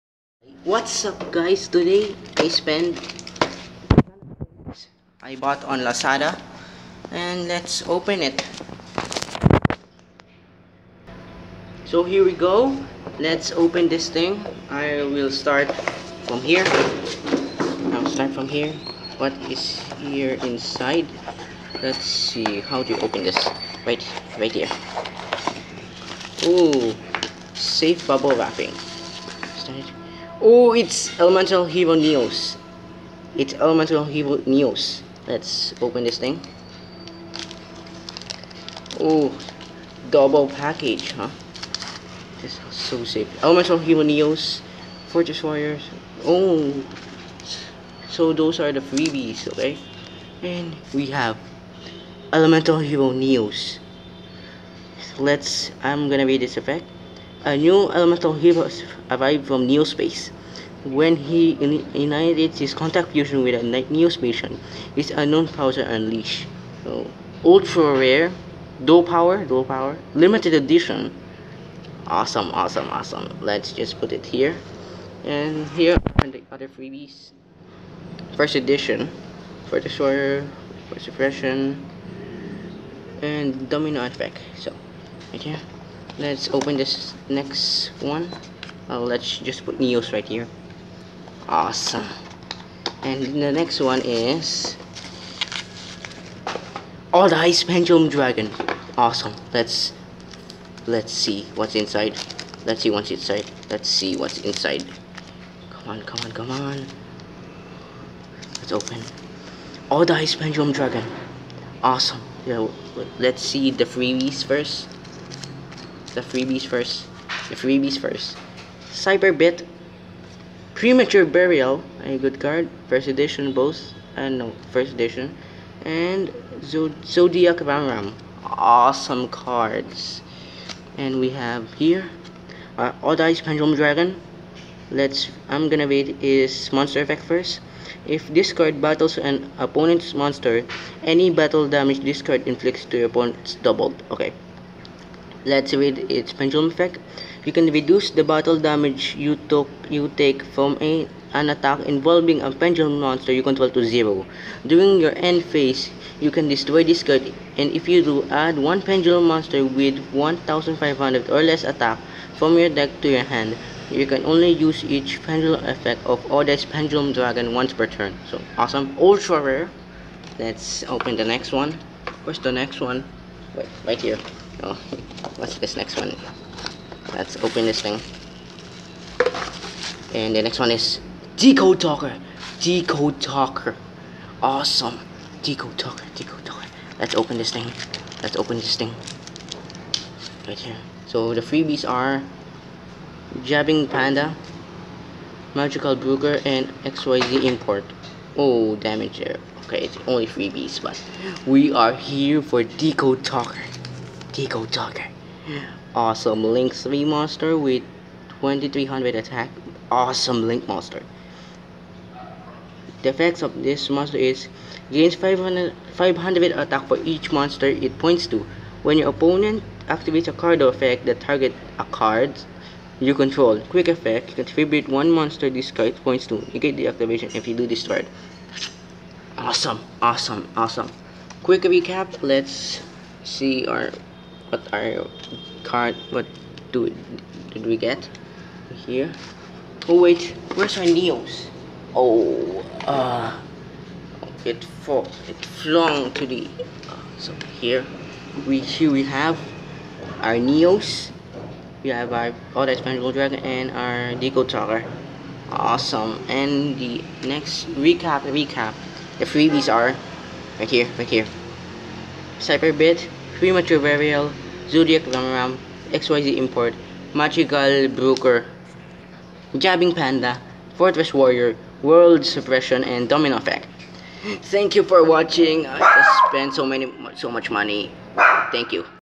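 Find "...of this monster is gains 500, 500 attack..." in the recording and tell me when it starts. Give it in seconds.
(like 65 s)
213 s.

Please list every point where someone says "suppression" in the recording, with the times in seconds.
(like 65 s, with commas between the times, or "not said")
80 s, 272 s.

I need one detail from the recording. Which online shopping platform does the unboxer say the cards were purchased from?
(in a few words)
Lazada.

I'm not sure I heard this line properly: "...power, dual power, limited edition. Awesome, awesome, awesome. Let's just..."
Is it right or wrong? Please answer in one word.
right.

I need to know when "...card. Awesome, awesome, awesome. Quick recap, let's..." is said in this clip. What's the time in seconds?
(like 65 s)
227 s.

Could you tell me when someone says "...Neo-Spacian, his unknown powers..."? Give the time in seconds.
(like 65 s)
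63 s.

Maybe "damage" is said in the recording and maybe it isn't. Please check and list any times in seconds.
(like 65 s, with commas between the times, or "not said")
141 s, 148 s, 198 s.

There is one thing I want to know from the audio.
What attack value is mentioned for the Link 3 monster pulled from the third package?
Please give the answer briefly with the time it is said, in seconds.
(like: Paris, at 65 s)
2300, at 208 s.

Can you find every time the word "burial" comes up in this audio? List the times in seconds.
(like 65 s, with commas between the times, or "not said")
121 s, 263 s.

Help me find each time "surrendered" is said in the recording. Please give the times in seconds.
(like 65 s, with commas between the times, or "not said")
not said.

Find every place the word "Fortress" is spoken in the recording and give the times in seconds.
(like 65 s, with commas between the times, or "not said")
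45 s, 270 s.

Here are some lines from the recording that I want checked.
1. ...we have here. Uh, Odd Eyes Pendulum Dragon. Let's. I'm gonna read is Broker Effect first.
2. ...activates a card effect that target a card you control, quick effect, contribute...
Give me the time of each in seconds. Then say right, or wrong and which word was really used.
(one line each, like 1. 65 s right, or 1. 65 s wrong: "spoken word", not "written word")
1. 131 s wrong: "Monster", not "Broker"
2. 219 s right.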